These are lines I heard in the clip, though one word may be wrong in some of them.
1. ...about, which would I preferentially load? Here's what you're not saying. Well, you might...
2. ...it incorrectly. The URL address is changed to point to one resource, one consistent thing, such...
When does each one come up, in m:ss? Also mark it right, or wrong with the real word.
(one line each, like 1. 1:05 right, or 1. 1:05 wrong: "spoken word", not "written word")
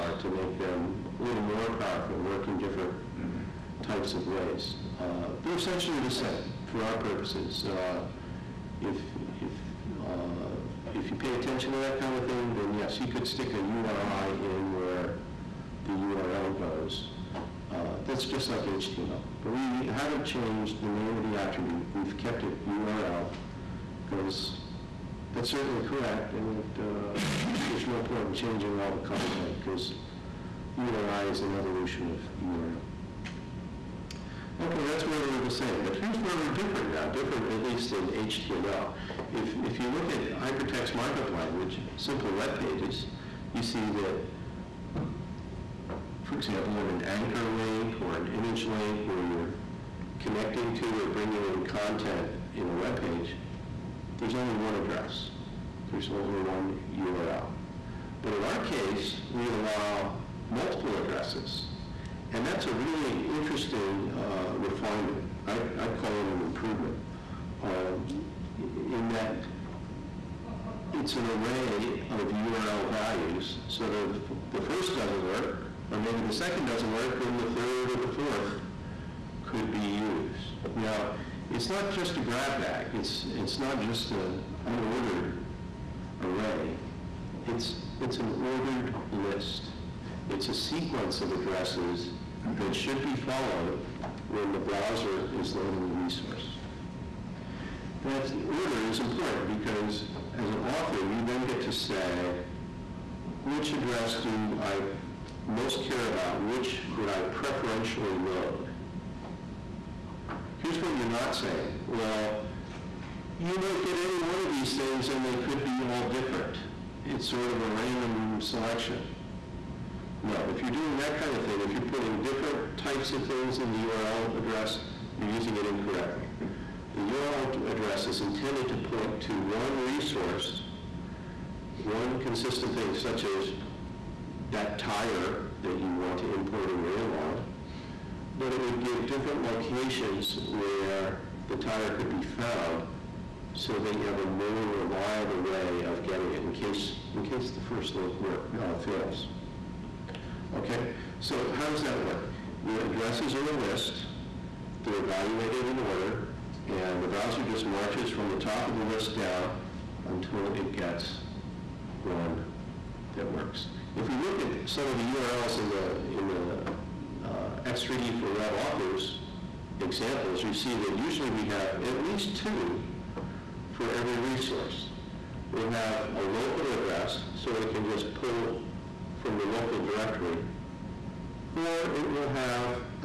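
1. 1:46 right
2. 2:05 wrong: "intended", not "changed".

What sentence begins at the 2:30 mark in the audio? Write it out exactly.
Okay, so how does that work?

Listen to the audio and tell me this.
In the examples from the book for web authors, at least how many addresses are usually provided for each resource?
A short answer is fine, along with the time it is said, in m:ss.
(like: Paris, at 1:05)
2, at 2:52.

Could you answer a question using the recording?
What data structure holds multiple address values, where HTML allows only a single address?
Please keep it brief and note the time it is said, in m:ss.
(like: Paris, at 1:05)
array of URL values, at 1:11.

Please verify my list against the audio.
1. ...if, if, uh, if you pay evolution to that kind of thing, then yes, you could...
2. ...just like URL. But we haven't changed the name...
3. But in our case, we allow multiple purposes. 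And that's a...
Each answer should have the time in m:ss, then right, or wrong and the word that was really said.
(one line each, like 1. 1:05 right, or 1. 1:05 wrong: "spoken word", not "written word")
1. 0:08 wrong: "attention", not "evolution"
2. 0:18 wrong: "HTML", not "URL"
3. 0:58 wrong: "addresses", not "purposes".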